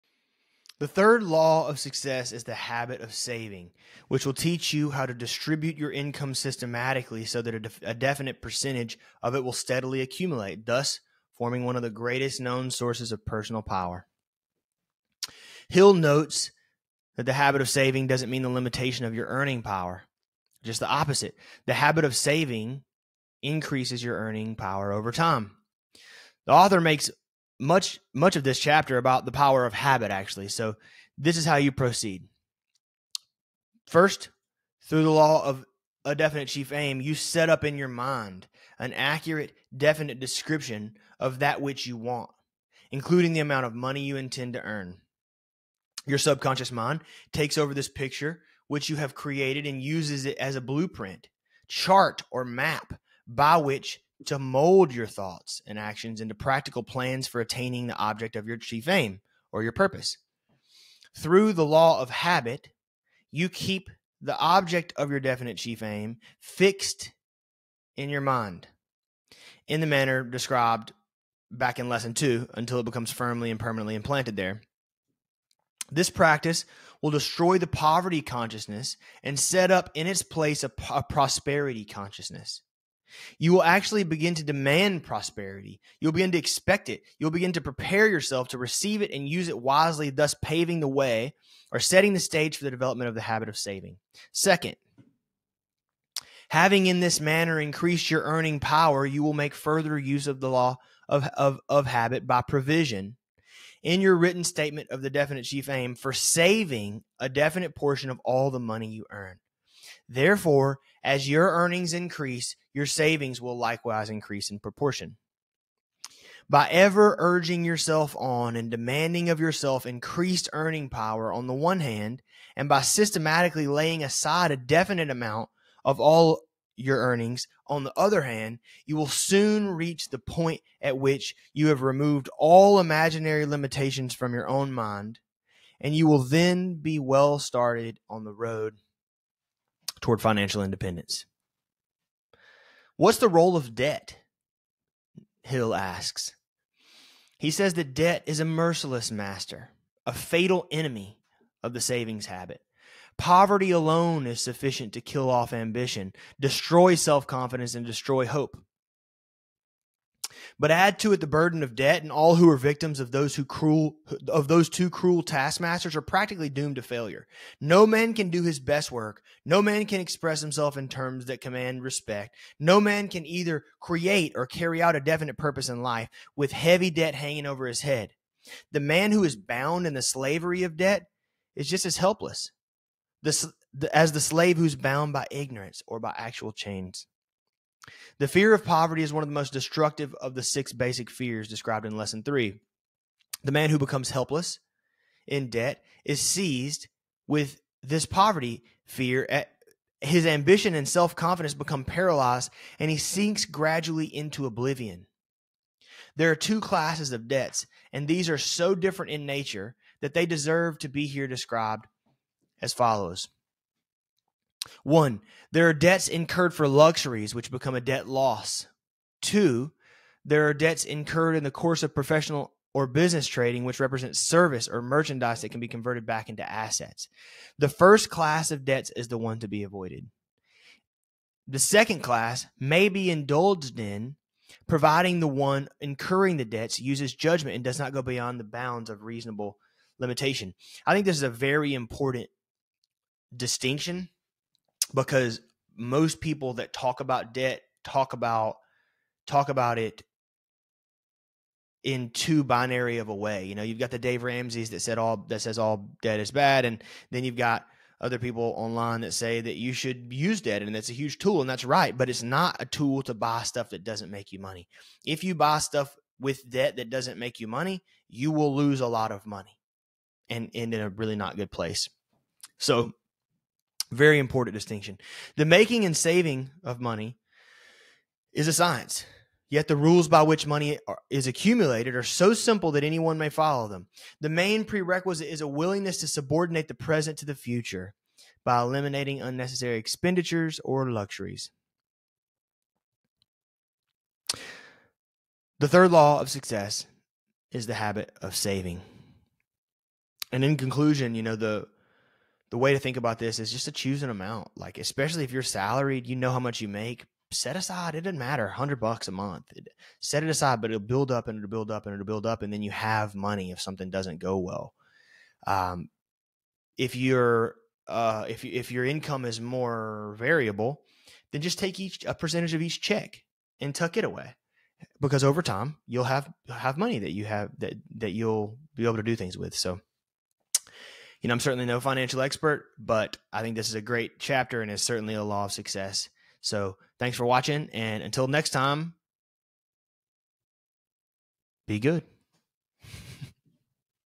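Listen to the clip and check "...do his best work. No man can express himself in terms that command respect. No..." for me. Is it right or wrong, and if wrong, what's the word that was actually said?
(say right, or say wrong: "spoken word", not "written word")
right.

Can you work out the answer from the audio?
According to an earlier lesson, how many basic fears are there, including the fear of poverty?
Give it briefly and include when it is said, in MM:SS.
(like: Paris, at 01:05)
6, at 03:10.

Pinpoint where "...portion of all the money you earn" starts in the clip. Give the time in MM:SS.
01:47.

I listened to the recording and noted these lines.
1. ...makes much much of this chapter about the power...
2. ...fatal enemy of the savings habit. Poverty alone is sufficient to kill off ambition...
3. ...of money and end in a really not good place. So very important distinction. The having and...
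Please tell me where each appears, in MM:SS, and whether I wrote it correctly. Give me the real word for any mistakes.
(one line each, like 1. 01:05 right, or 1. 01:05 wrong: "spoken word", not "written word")
1. 00:26 right
2. 02:30 right
3. 04:29 wrong: "making", not "having".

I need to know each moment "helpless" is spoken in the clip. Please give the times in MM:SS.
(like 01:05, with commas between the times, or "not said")
03:01, 03:14.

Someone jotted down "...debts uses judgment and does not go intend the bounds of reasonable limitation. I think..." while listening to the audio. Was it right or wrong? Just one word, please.
wrong.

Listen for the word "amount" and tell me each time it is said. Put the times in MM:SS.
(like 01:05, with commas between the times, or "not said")
00:43, 02:05, 05:04.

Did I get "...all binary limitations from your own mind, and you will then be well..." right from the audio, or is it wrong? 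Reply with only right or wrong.
wrong.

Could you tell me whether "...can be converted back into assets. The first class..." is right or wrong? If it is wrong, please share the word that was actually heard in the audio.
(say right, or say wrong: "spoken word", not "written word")
right.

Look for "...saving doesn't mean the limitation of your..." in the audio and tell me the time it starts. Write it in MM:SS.
00:17.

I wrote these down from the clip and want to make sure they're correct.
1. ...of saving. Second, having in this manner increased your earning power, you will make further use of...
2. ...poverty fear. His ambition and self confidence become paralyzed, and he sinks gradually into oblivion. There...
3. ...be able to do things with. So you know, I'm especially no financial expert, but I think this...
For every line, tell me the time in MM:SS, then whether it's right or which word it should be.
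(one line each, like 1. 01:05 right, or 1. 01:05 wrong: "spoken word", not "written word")
1. 01:33 right
2. 03:18 right
3. 05:28 wrong: "certainly", not "especially".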